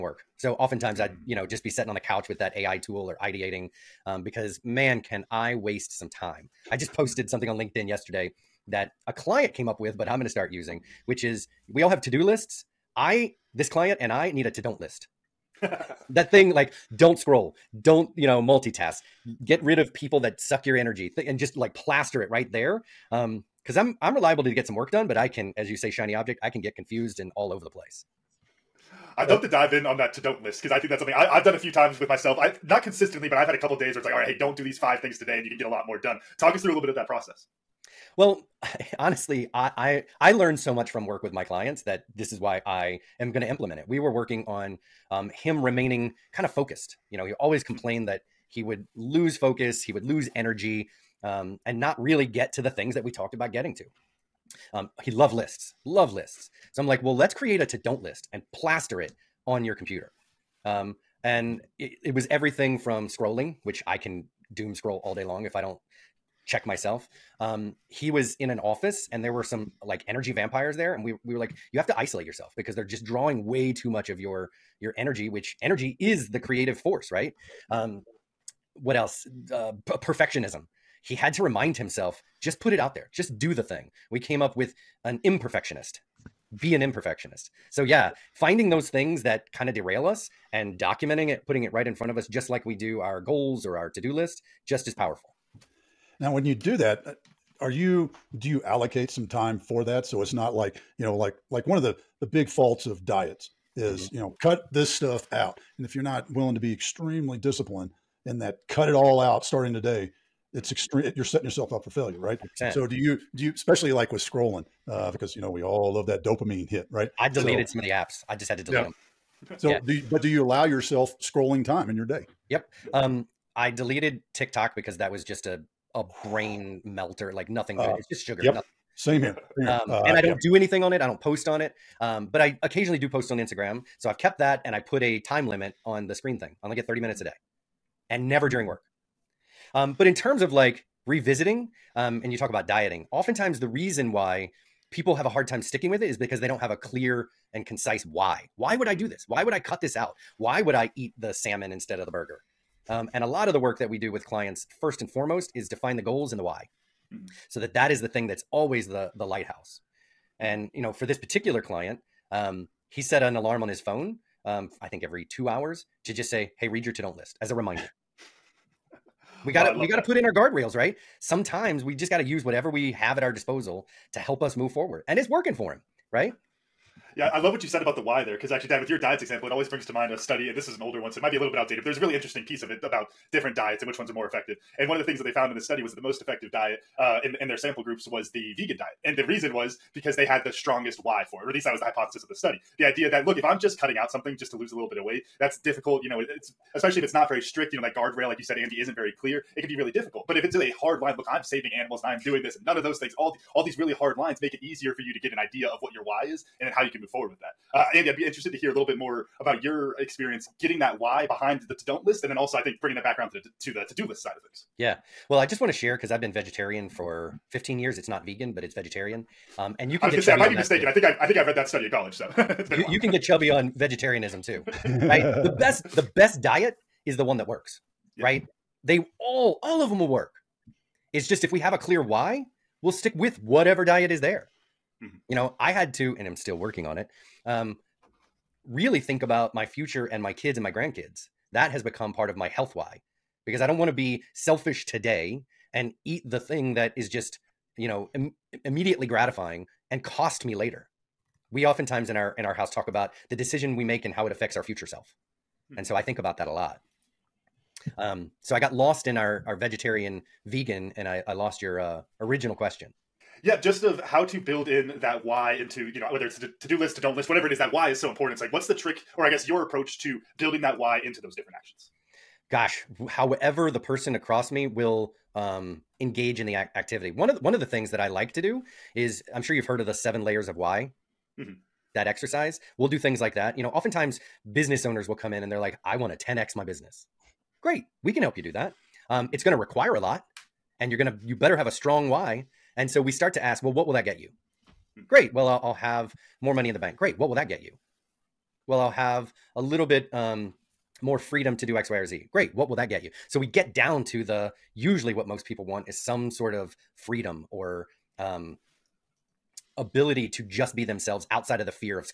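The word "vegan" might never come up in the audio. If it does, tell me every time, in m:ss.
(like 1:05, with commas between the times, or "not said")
3:08, 3:38, 4:20.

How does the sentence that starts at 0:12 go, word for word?
I, this client and I need a to don't list.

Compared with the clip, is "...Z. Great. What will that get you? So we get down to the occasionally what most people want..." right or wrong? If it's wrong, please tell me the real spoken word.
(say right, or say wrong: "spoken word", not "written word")
wrong: "usually", not "occasionally".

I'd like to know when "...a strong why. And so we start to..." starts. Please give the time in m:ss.
4:51.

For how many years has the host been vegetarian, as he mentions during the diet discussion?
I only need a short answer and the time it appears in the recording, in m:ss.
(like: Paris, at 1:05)
15, at 3:37.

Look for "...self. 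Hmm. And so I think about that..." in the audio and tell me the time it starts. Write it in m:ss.
4:14.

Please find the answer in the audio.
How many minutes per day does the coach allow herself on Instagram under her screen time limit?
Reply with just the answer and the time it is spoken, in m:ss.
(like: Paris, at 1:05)
30, at 2:16.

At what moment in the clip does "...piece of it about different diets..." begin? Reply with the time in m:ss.
3:02.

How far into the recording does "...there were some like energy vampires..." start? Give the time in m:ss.
1:09.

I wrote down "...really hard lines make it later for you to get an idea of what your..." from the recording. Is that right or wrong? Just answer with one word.
wrong.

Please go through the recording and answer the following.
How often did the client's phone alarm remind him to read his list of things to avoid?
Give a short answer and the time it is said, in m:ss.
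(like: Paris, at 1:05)
every two hours, at 2:45.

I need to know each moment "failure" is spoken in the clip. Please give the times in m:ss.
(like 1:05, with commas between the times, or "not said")
1:51.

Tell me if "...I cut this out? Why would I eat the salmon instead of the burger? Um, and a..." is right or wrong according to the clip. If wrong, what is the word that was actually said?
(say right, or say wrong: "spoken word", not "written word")
right.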